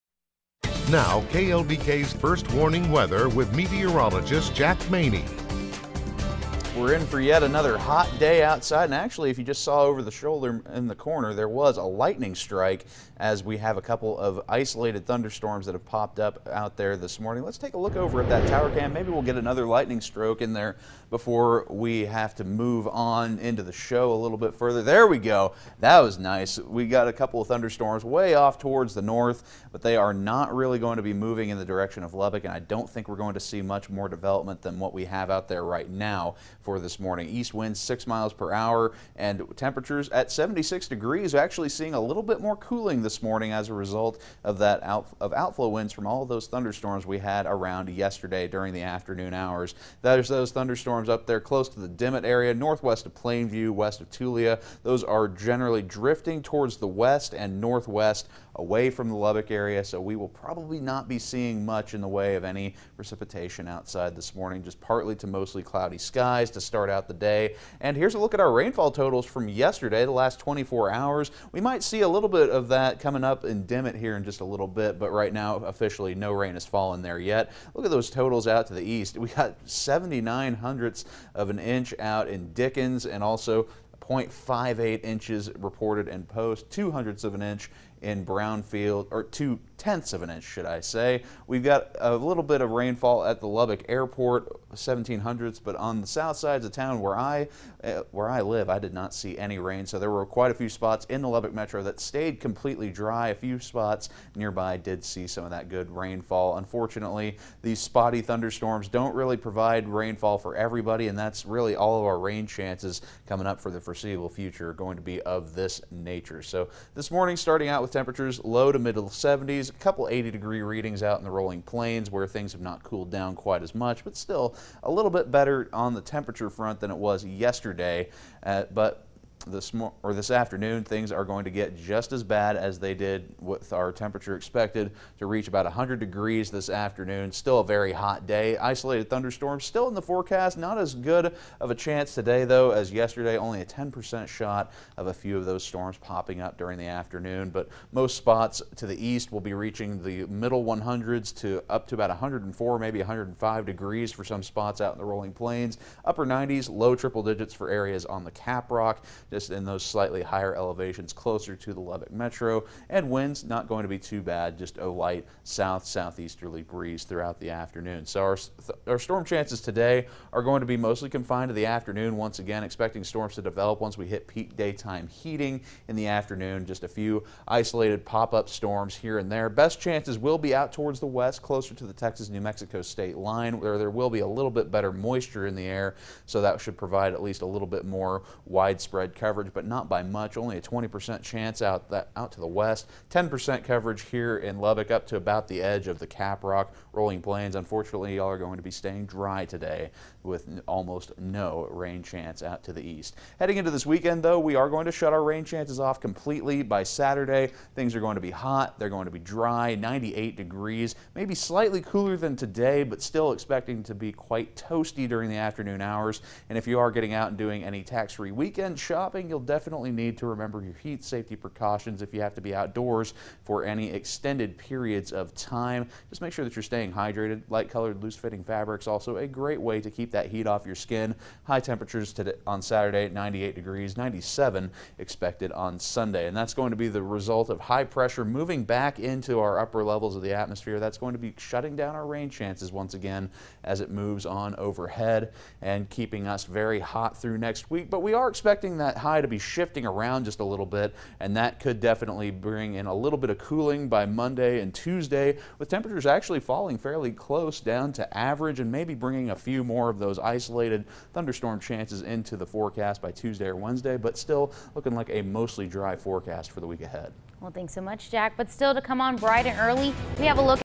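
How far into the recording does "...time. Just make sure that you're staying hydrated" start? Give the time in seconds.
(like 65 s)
225 s.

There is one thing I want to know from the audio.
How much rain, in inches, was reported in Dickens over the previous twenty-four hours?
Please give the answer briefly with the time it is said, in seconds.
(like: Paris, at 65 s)
0.79 inches, at 79 s.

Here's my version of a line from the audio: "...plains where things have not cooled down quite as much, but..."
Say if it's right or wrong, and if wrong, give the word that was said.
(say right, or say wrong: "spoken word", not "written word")
right.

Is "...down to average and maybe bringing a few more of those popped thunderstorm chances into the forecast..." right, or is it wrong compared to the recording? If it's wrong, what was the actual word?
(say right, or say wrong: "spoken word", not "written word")
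wrong: "isolated", not "popped".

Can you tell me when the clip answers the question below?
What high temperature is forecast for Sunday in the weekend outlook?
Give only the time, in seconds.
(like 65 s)
233 s.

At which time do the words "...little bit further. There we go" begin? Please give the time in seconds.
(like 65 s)
24 s.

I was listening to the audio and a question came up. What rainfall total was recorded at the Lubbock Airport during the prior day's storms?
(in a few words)
0.17 inches.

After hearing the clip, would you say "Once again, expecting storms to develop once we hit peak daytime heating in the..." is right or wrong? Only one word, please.
right.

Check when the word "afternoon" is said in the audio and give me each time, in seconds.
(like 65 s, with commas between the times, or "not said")
48 s, 130 s, 136 s, 146 s, 167 s, 171 s, 176 s, 215 s.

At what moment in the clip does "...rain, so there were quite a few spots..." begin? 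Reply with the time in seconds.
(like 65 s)
99 s.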